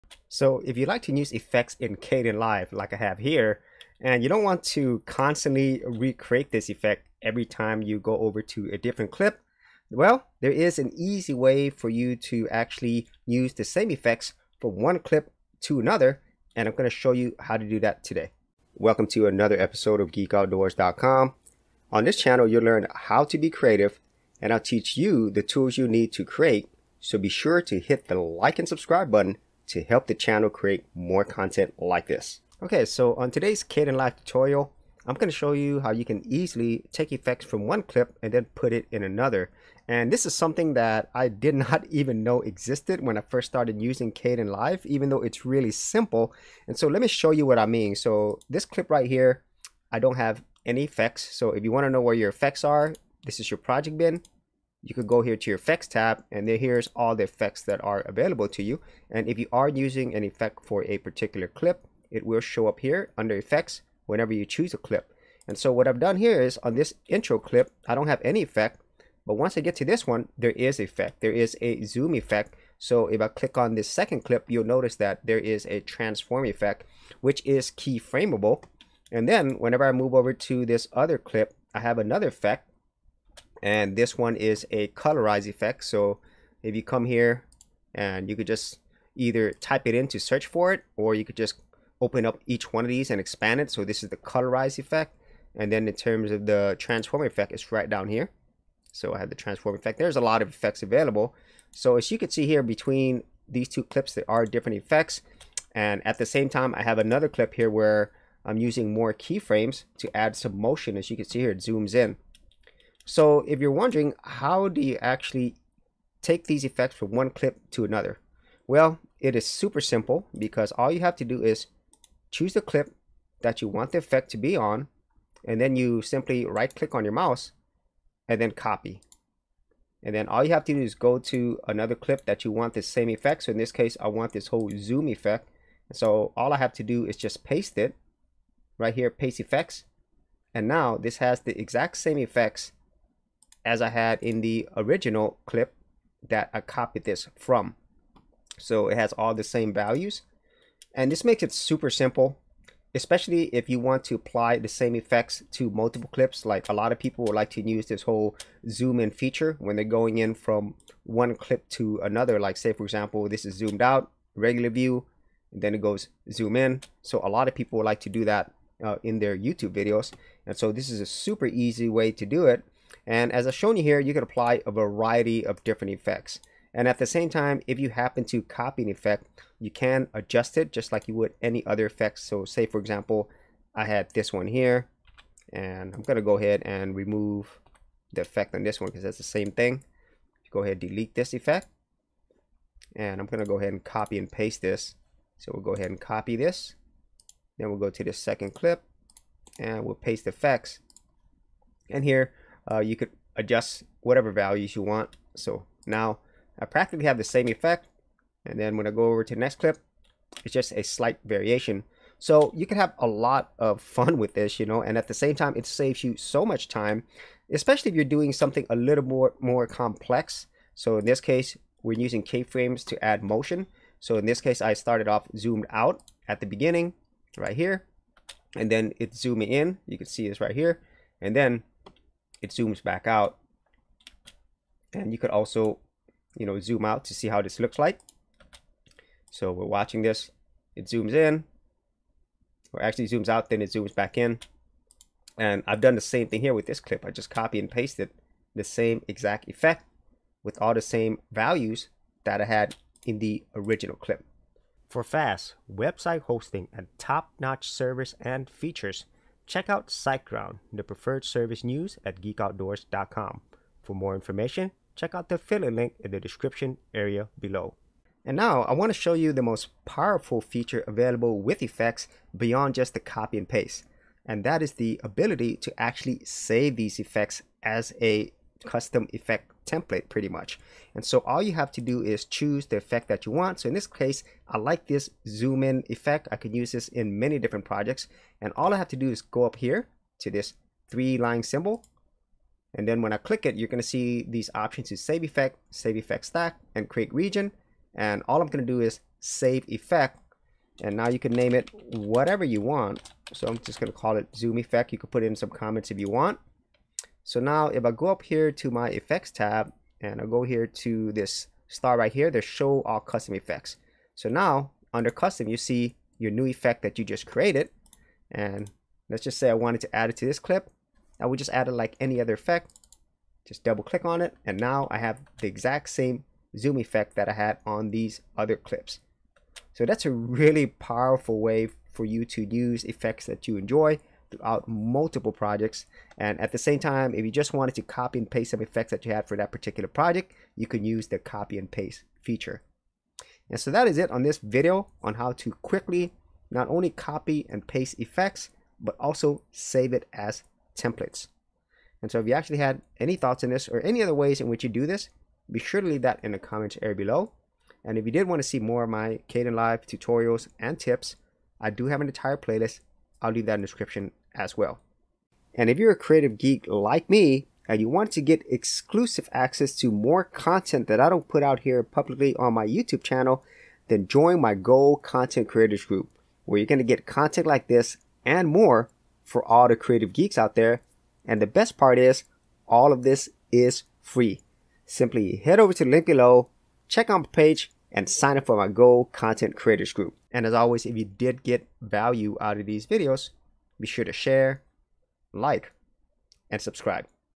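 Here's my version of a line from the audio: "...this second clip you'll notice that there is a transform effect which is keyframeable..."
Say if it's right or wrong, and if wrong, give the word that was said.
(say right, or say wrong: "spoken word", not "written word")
right.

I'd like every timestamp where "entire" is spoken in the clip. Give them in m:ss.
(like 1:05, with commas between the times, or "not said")
6:02.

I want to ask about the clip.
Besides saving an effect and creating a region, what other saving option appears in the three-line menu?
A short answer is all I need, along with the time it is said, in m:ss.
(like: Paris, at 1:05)
save effect stack, at 4:55.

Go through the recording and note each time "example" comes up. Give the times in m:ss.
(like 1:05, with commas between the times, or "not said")
2:42, 3:02.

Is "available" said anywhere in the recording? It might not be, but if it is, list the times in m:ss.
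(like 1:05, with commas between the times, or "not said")
0:58, 1:40, 4:30.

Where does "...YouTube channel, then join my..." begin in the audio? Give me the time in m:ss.
6:12.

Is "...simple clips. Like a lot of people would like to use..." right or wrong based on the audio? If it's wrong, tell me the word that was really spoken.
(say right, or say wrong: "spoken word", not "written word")
wrong: "multiple", not "simple".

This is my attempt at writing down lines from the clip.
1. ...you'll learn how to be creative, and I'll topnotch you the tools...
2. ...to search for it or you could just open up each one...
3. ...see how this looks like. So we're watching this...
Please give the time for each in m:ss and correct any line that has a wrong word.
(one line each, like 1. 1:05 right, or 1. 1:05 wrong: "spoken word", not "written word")
1. 0:22 wrong: "teach", not "topnotch"
2. 1:30 right
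3. 3:57 right.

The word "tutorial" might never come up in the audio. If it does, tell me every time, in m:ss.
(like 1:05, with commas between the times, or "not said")
0:34, 5:59.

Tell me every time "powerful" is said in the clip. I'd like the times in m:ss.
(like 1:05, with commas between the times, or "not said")
4:29, 5:30.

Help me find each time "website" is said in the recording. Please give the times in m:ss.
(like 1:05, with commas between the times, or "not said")
4:15.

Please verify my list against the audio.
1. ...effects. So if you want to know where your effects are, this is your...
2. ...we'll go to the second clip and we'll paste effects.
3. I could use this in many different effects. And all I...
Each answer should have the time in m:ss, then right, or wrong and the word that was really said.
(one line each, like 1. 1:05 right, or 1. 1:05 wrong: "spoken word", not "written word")
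1. 0:50 right
2. 3:17 right
3. 4:46 wrong: "projects", not "effects".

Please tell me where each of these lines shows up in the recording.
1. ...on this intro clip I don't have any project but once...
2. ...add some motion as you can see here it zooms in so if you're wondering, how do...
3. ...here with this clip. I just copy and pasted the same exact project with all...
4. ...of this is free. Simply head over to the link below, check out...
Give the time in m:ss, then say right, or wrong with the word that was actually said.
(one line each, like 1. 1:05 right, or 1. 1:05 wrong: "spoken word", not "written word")
1. 1:06 wrong: "effect", not "project"
2. 1:50 right
3. 4:06 wrong: "effect", not "project"
4. 6:22 right.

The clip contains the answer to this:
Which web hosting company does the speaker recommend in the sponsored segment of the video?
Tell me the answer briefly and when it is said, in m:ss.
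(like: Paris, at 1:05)
SiteGround, at 4:19.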